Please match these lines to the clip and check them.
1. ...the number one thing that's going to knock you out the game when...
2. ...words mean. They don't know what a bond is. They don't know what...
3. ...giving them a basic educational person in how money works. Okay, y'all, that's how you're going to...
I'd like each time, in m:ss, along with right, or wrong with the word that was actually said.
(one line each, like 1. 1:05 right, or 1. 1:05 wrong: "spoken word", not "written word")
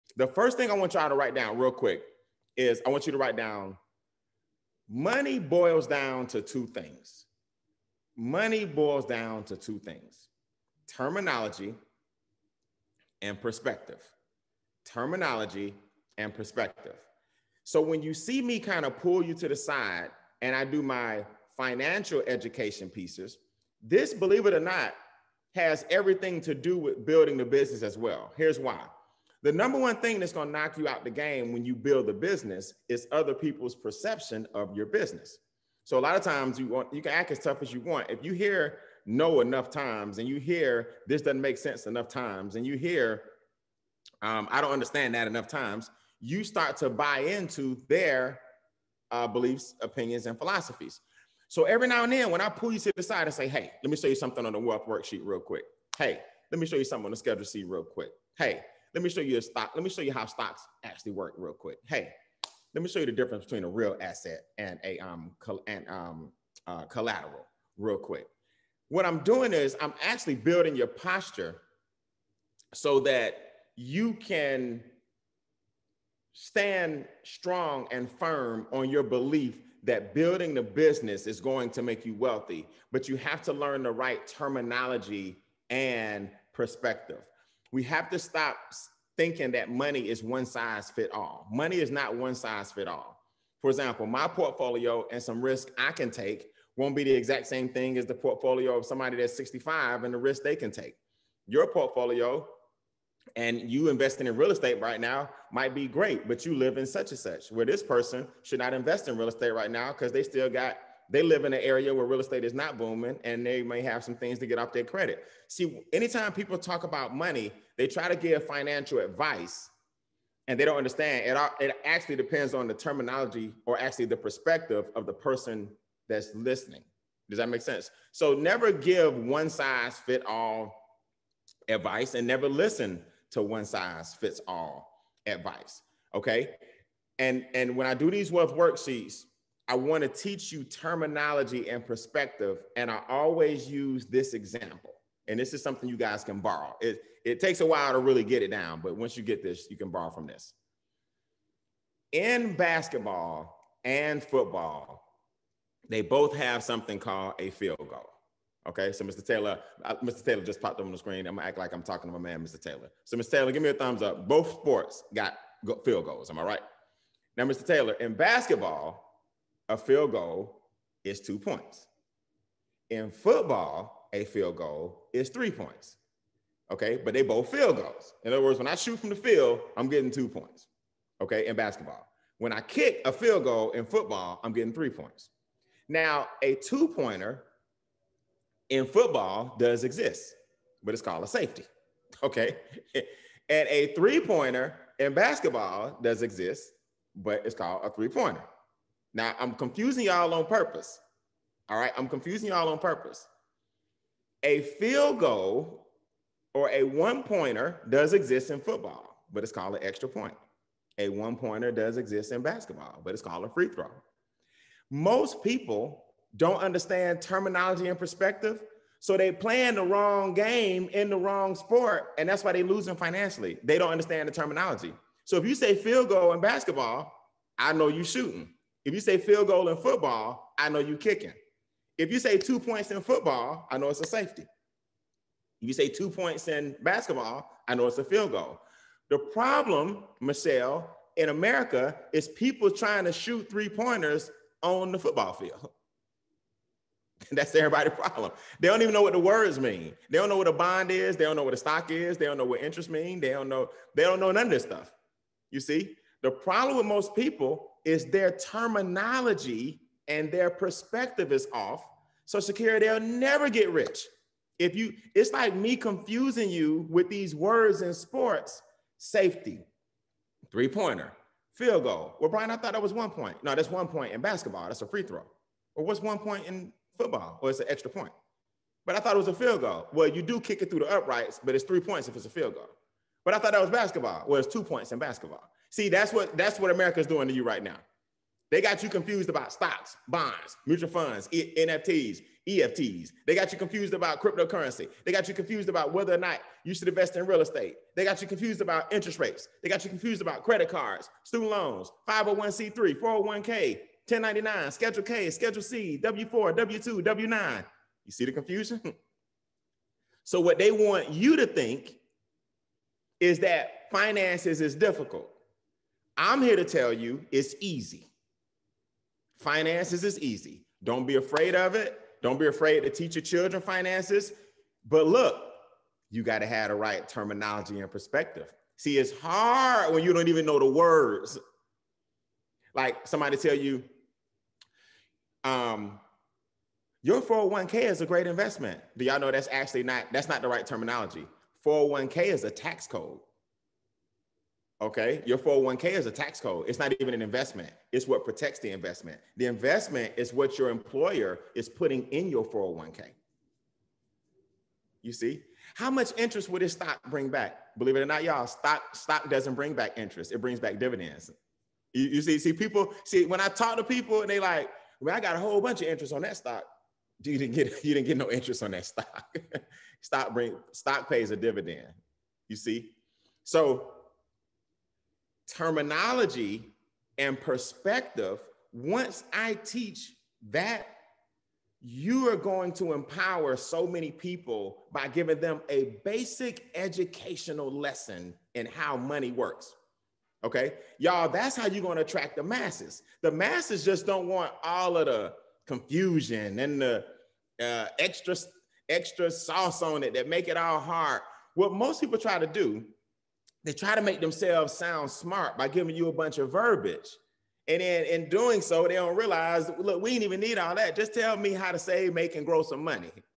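1. 0:29 right
2. 4:09 right
3. 6:25 wrong: "lesson", not "person".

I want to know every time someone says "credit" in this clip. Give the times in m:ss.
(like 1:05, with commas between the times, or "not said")
1:54, 5:00.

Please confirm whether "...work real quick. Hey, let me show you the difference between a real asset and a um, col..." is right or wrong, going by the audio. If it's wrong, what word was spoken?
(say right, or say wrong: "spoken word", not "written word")
right.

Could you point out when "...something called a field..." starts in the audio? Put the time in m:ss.
2:36.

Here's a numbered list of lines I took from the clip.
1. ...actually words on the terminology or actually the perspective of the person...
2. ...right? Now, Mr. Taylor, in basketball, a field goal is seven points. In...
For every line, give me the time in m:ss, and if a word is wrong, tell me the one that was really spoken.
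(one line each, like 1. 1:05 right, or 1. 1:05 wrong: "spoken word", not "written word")
1. 2:01 wrong: "depends", not "words"
2. 2:46 wrong: "two", not "seven".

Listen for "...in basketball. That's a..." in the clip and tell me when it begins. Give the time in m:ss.
4:34.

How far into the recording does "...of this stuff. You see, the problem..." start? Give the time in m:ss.
4:14.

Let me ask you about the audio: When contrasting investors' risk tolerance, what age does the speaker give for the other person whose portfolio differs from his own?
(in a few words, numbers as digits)
65.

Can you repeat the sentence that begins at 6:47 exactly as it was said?
And then in doing so, they don't realize, look, we didn't even need all that.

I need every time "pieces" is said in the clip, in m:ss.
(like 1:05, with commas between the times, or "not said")
0:22.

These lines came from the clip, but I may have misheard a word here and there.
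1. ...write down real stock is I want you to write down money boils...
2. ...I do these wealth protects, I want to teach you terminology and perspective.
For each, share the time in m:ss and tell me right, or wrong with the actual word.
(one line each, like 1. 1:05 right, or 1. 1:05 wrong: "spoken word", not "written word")
1. 0:01 wrong: "quick", not "stock"
2. 2:17 wrong: "worksheets", not "protects".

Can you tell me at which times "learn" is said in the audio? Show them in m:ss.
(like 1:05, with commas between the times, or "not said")
1:23.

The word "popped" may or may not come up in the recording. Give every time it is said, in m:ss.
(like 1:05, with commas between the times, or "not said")
2:40.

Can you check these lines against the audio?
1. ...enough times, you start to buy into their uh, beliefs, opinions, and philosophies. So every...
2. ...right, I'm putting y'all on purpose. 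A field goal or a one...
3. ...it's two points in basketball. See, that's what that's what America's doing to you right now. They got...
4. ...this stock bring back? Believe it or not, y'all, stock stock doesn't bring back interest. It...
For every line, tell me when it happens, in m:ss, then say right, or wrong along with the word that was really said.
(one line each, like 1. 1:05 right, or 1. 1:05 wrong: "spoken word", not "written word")
1. 0:45 right
2. 3:21 wrong: "confusing", not "putting"
3. 4:44 right
4. 5:56 right.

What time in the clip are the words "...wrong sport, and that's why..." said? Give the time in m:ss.
3:41.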